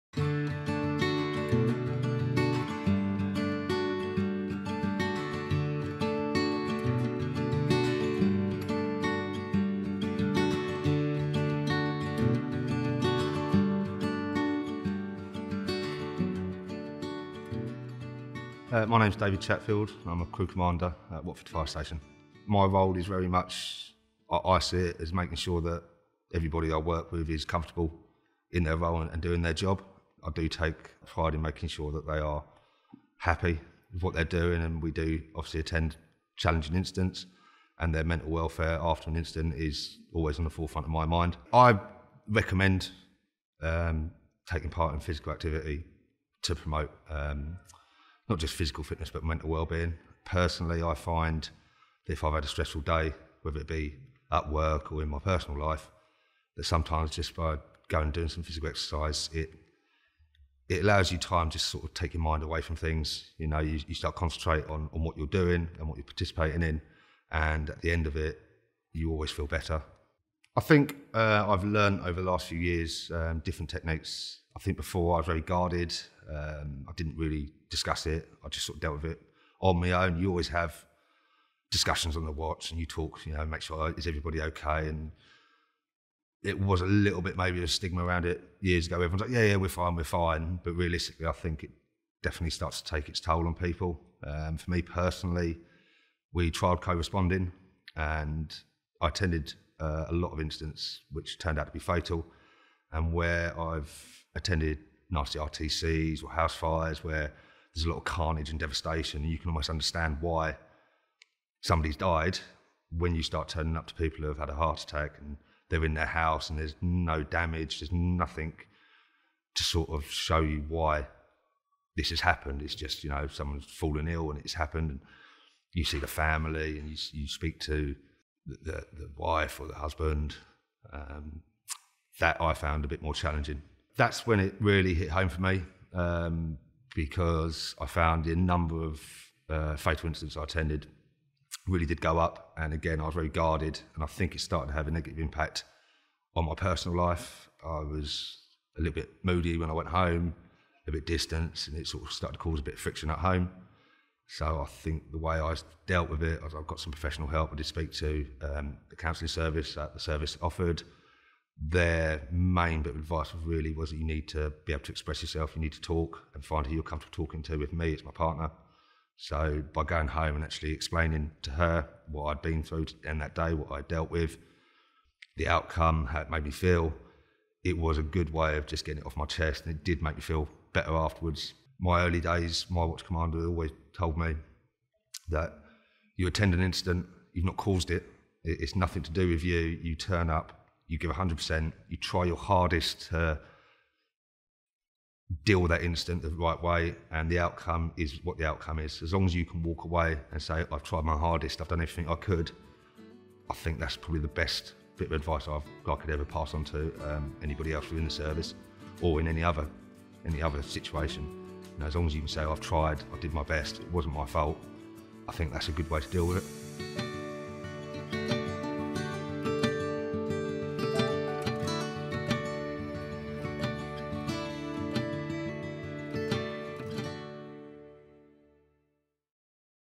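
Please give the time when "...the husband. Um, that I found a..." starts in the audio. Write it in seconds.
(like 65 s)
129 s.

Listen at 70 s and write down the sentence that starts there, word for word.
I think uh, I've learned over the last few years um, different techniques.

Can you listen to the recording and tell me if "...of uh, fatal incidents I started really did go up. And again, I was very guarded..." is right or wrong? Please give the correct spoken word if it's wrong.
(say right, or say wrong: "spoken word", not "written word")
wrong: "attended", not "started".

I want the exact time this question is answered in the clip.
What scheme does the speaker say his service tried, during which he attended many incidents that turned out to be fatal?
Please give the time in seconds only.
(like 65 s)
96 s.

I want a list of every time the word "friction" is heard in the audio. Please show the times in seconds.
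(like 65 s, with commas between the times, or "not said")
152 s.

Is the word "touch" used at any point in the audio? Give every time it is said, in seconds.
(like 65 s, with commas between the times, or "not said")
not said.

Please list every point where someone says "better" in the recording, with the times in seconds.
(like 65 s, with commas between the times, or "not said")
69 s, 180 s.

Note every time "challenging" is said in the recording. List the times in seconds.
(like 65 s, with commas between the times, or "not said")
36 s, 133 s.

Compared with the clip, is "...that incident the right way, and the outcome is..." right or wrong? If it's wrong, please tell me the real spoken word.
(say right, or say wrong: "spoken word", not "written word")
right.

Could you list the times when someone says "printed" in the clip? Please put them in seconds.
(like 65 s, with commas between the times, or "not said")
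not said.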